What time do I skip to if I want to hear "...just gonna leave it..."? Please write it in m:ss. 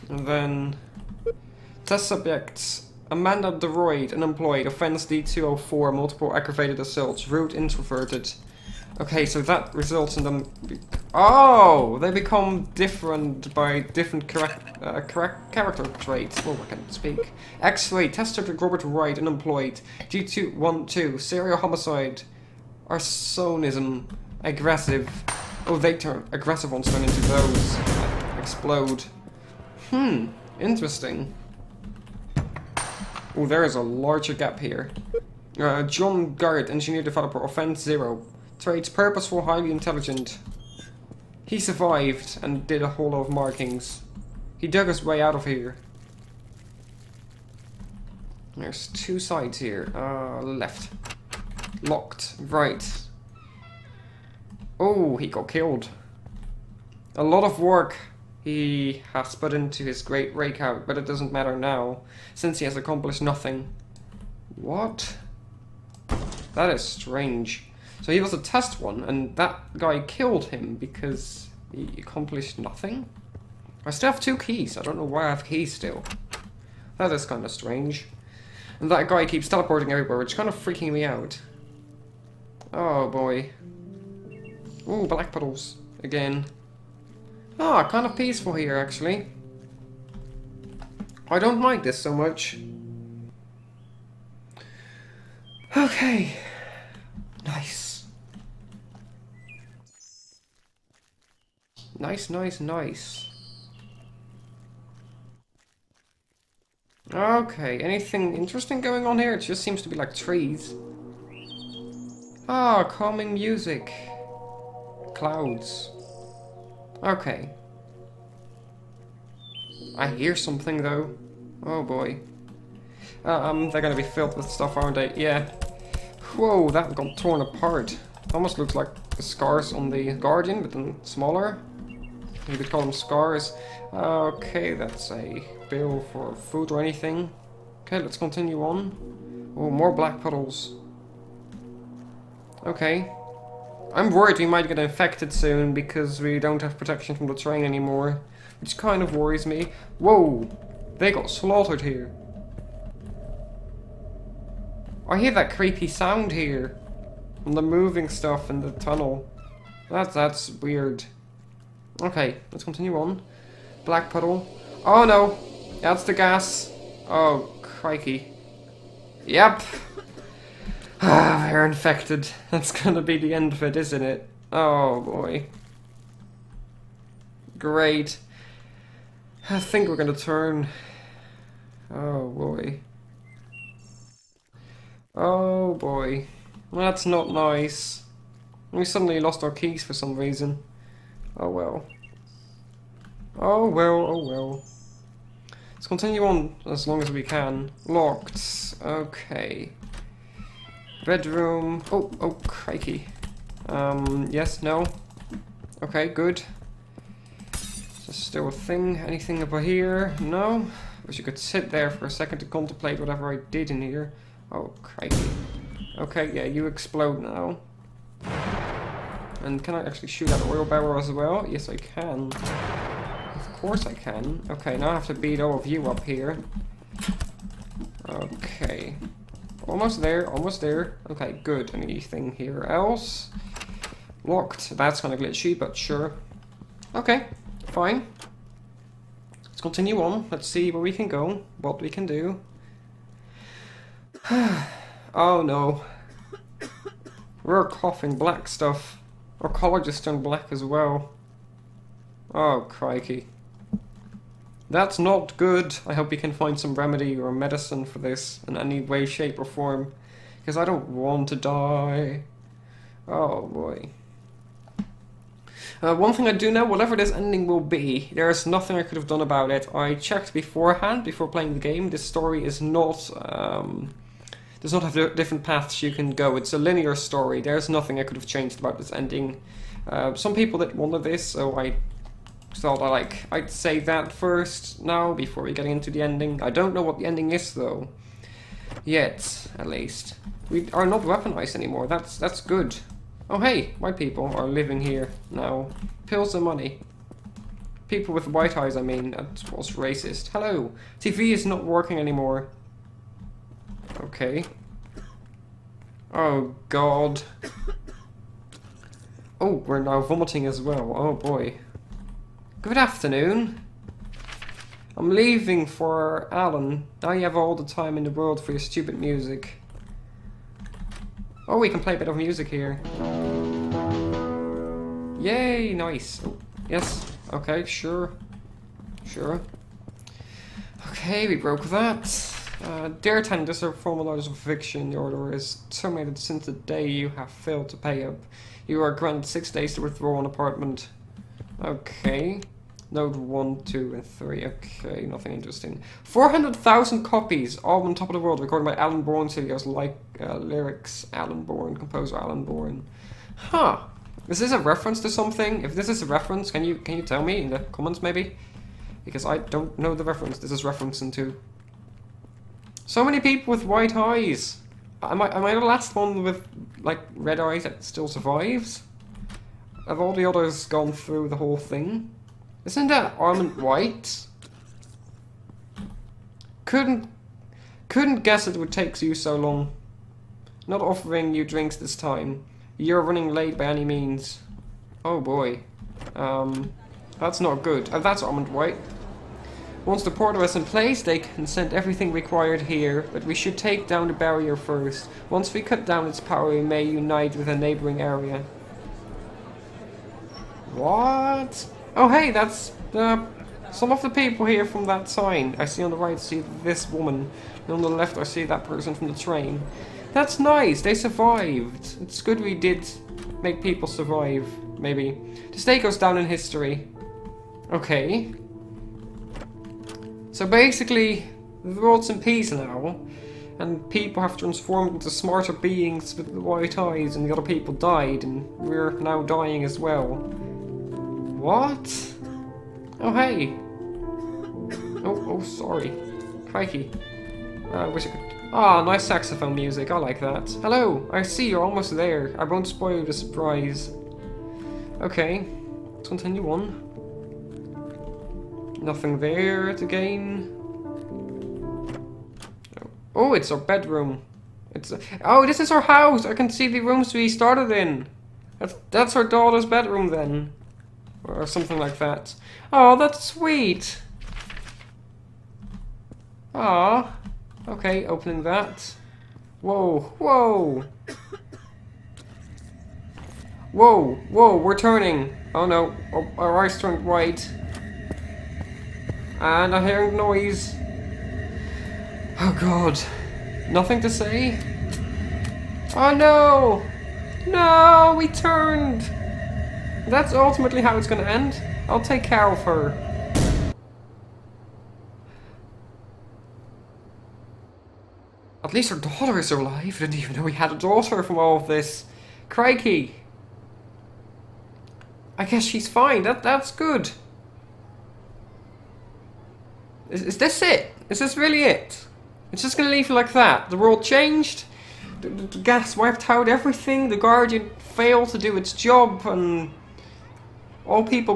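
8:32.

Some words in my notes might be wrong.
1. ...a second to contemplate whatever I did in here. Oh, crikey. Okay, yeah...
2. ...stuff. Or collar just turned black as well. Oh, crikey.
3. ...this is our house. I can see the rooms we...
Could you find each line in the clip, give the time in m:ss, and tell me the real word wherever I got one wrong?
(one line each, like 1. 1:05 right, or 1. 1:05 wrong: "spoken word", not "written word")
1. 3:32 right
2. 4:08 right
3. 7:35 right.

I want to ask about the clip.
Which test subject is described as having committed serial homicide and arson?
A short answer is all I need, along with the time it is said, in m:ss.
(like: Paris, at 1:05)
Robert Wright, at 0:18.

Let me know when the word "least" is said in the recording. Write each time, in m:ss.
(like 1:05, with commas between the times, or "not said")
4:49, 8:18.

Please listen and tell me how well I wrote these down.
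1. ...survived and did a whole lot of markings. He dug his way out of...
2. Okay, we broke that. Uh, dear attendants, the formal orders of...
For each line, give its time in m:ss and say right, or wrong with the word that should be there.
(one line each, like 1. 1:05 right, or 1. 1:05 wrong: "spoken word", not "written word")
1. 0:41 right
2. 5:30 right.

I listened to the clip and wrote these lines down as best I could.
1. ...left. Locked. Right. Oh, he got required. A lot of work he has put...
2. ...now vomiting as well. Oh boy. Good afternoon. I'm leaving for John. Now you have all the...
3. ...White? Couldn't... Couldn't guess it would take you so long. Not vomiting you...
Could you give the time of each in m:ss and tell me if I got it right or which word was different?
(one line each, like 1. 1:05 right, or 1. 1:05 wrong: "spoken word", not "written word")
1. 0:50 wrong: "killed", not "required"
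2. 5:09 wrong: "Alan", not "John"
3. 6:13 wrong: "offering", not "vomiting".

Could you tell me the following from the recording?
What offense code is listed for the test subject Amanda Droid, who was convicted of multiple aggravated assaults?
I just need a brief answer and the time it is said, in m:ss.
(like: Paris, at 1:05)
D204, at 0:05.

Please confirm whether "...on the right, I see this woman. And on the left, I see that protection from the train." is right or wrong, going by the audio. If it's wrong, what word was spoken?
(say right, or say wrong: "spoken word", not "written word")
wrong: "person", not "protection".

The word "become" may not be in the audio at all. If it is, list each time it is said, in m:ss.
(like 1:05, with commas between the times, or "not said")
0:12, 2:12.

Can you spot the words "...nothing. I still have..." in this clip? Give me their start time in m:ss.
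1:12.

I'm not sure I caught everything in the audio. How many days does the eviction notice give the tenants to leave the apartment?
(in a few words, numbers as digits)
6.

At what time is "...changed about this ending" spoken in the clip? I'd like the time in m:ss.
4:38.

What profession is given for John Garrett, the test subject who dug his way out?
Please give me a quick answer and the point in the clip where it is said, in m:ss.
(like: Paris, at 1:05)
Engineer developer, at 0:36.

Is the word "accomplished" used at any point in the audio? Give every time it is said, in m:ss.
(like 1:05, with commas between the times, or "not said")
1:02, 1:11.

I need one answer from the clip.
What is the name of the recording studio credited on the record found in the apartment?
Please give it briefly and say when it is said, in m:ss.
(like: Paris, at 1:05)
Alan Bourne Studios, at 5:48.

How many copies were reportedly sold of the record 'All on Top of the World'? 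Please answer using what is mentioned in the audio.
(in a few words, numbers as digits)
400,000.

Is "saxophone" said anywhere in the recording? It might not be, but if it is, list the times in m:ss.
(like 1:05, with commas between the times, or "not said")
7:19.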